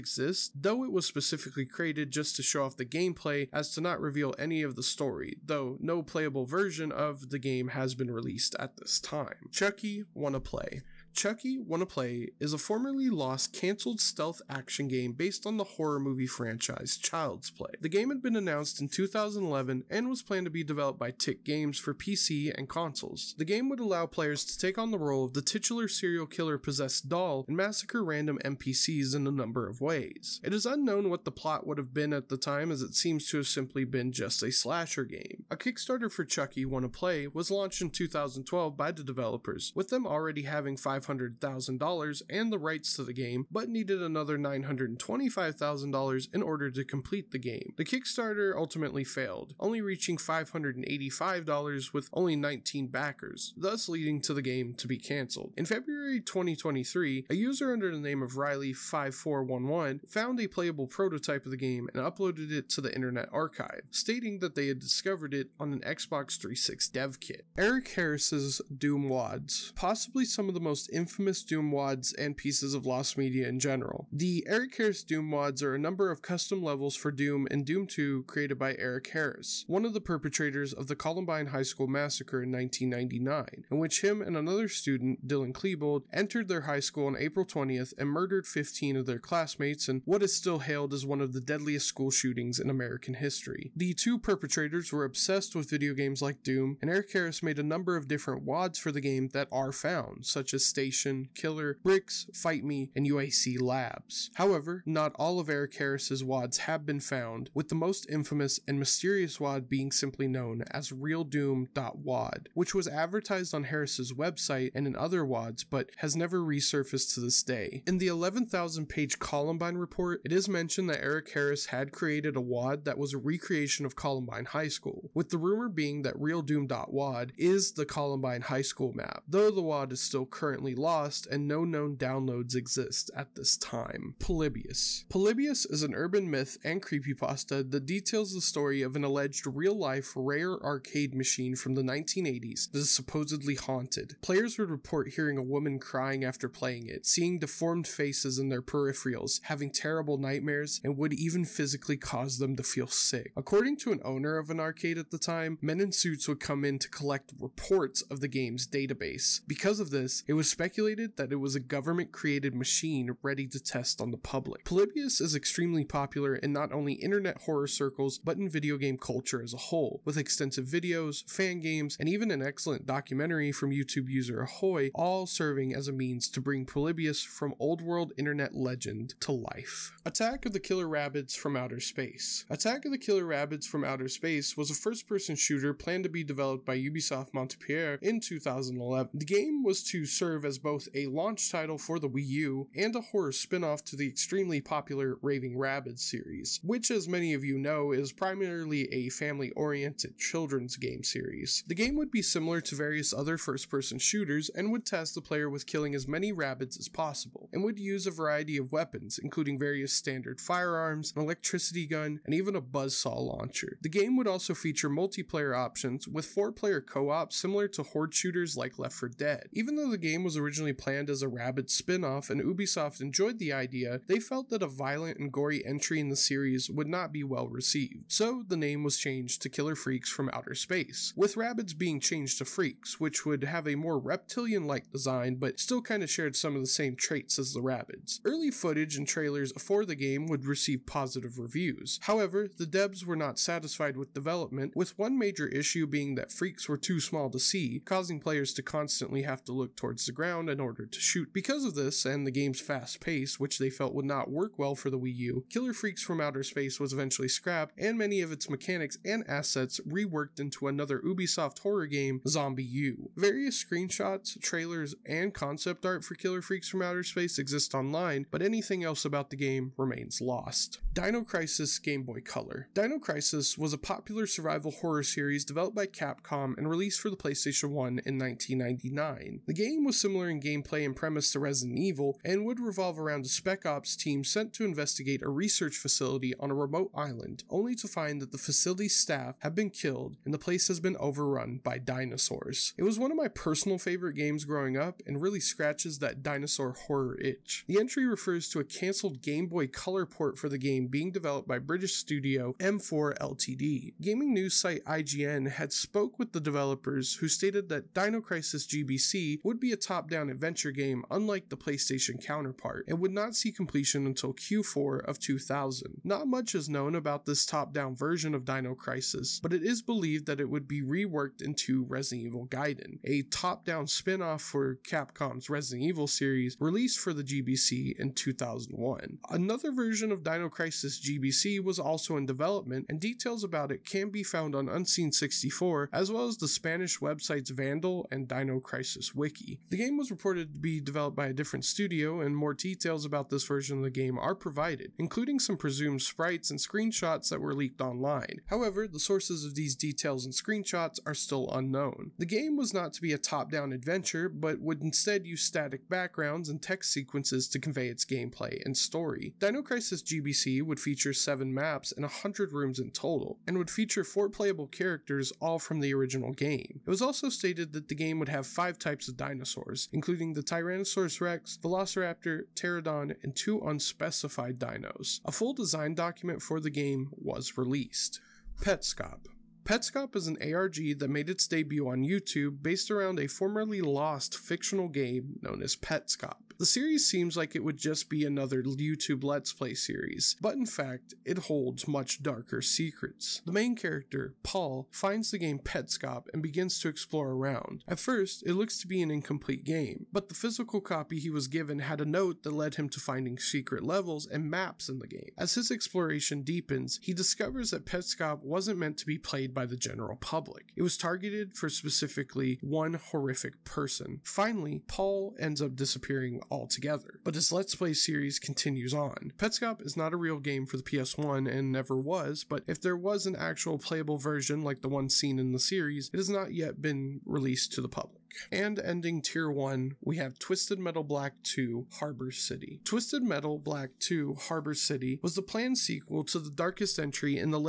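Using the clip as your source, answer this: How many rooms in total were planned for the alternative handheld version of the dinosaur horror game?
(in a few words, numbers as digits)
100.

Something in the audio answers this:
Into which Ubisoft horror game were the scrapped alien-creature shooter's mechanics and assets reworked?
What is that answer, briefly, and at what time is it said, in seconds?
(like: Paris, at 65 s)
ZombiU, at 262 s.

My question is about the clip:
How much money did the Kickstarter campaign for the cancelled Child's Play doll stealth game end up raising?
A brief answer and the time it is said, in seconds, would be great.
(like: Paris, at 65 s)
$585, at 50 s.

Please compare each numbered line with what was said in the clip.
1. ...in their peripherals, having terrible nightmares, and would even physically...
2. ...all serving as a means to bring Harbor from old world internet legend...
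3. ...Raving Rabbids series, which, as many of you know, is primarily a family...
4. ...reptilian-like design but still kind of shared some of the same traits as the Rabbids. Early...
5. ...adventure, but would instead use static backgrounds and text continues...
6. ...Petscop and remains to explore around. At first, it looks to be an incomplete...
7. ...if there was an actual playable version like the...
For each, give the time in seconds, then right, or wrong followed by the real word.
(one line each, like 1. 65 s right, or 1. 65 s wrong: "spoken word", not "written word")
1. 148 s right
2. 174 s wrong: "Polybius", not "Harbor"
3. 195 s right
4. 233 s right
5. 353 s wrong: "sequences", not "continues"
6. 395 s wrong: "begins", not "remains"
7. 422 s right.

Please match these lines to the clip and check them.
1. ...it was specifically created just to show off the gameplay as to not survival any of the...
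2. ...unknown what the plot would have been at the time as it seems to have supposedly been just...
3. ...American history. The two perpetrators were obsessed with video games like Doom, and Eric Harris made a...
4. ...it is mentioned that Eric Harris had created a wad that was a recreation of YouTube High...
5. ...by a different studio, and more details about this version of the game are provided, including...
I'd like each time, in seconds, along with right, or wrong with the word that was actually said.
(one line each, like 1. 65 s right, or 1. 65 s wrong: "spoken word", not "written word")
1. 0 s wrong: "reveal", not "survival"
2. 30 s wrong: "simply", not "supposedly"
3. 92 s right
4. 120 s wrong: "Columbine", not "YouTube"
5. 341 s right.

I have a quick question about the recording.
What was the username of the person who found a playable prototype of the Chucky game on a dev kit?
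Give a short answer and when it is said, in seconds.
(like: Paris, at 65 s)
Riley5411, at 58 s.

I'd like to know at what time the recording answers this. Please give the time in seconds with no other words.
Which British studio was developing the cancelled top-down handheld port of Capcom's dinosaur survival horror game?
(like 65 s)
302 s.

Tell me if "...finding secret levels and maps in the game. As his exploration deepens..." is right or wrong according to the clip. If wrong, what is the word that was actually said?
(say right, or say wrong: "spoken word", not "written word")
right.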